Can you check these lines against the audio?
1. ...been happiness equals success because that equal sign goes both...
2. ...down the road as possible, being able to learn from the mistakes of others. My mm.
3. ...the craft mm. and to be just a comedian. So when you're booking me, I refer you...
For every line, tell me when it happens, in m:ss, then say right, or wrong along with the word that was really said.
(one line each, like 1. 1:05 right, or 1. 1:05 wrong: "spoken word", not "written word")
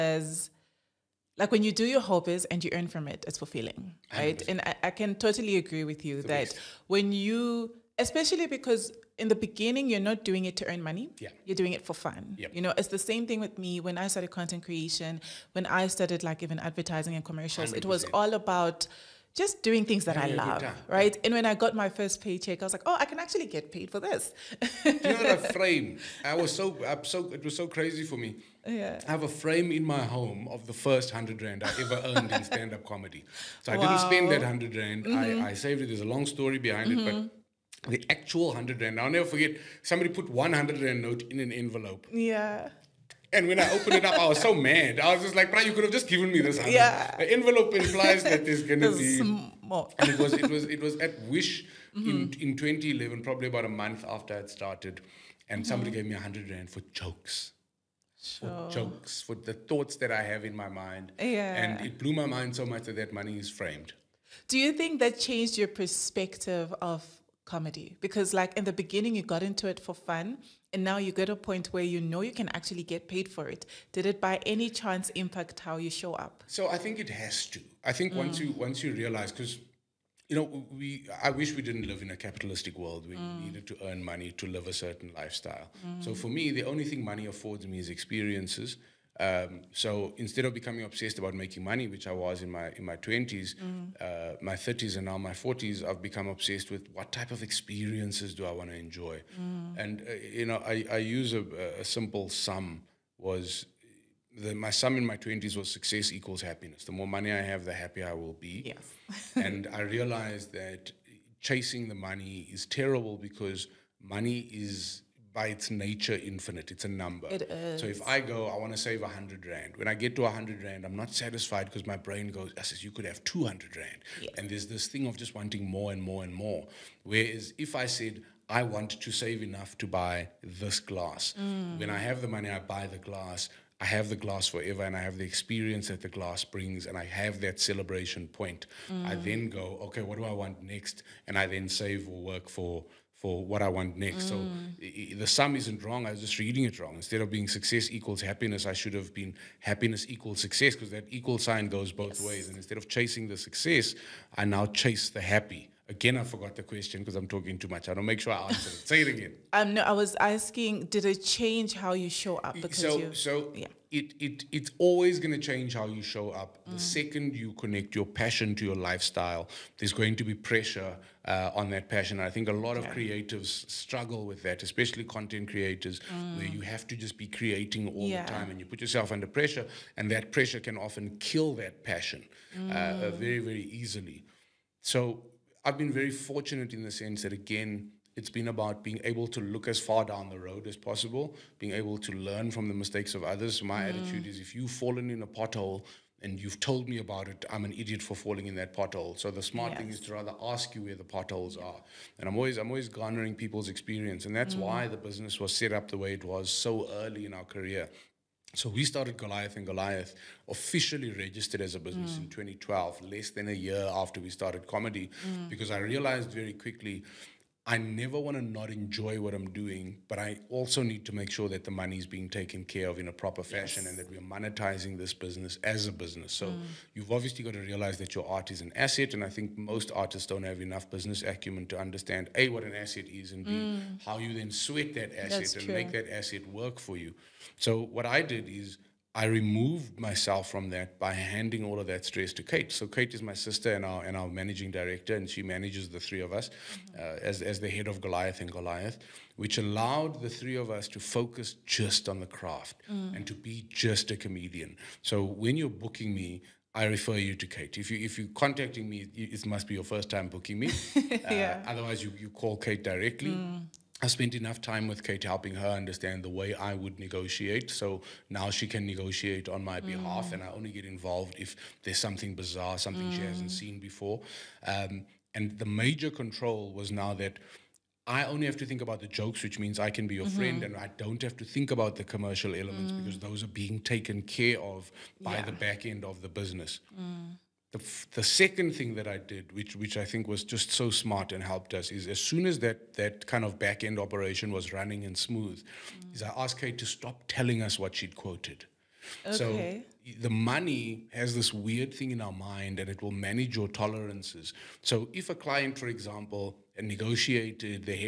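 1. 2:29 right
2. 3:10 right
3. 4:12 right.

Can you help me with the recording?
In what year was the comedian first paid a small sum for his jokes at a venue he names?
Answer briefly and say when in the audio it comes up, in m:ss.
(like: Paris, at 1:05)
2011, at 0:52.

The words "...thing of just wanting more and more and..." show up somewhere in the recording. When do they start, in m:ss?
2:04.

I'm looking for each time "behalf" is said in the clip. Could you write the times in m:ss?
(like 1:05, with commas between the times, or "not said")
4:29.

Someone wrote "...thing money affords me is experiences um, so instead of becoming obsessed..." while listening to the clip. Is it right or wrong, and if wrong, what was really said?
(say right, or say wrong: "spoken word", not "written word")
right.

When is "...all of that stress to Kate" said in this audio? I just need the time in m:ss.
4:01.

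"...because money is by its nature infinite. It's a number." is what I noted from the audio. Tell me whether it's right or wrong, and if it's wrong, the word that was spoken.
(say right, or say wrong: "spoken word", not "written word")
right.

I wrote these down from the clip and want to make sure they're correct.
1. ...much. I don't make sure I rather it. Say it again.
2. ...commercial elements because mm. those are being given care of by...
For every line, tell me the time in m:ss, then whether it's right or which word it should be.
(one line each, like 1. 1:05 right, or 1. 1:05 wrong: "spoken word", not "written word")
1. 2:37 wrong: "answer", not "rather"
2. 4:42 wrong: "taken", not "given".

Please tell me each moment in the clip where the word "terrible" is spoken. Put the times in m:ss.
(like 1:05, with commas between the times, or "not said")
1:52.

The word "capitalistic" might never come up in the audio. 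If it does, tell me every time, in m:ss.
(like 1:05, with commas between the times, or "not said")
1:22.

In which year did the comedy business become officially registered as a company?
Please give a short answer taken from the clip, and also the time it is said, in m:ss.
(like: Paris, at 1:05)
2012, at 3:32.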